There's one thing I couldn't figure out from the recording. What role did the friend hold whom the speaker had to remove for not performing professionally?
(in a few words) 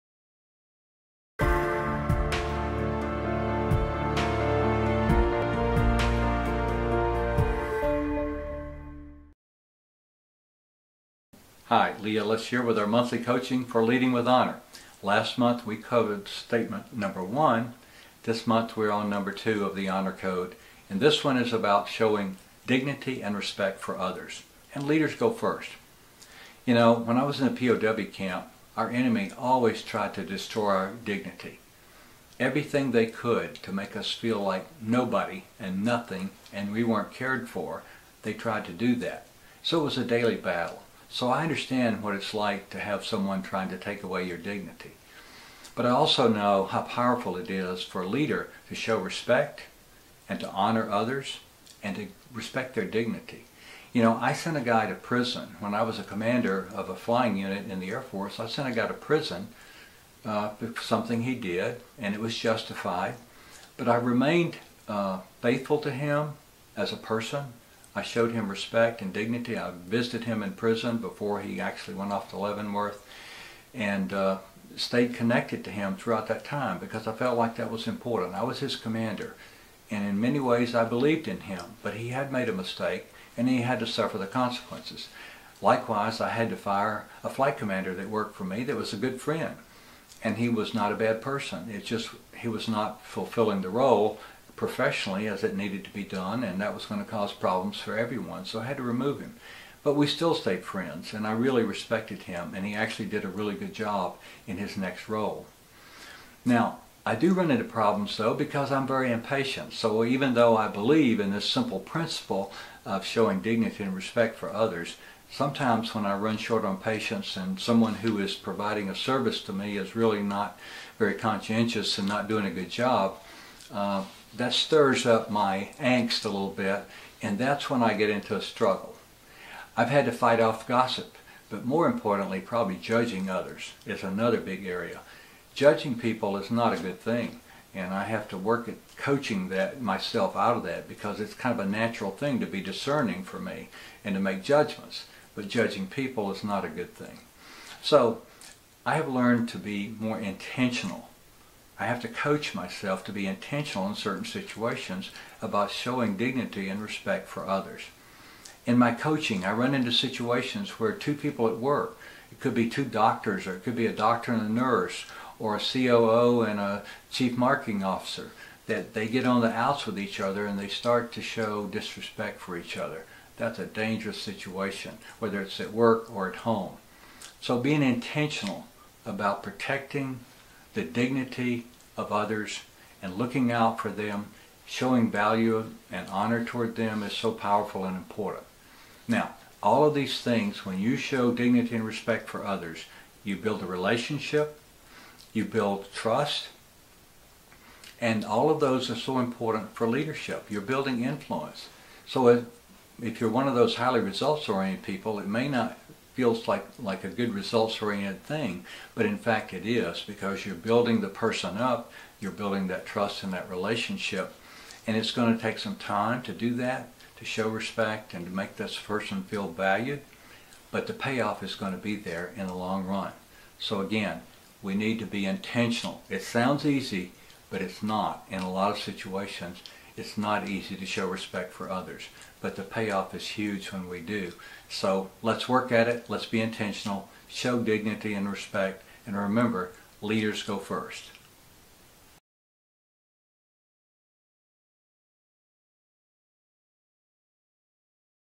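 Flight commander.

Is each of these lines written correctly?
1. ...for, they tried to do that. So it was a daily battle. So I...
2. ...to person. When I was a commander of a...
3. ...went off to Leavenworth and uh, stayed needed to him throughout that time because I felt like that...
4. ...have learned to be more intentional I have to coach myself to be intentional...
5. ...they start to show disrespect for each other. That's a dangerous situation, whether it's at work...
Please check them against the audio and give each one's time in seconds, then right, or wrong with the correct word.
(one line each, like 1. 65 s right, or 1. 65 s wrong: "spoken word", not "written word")
1. 37 s right
2. 54 s wrong: "prison", not "person"
3. 71 s wrong: "connected", not "needed"
4. 148 s right
5. 170 s right.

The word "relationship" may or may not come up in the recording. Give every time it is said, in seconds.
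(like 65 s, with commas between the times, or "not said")
193 s, 213 s.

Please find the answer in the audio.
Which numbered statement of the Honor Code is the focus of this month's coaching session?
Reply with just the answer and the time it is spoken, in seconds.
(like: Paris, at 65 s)
2, at 19 s.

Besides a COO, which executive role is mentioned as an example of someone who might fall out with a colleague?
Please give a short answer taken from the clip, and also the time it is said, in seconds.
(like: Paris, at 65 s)
Chief marketing officer, at 167 s.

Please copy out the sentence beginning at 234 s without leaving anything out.
So let's work at it, let's be intentional, show dignity and respect, and remember, leaders go first.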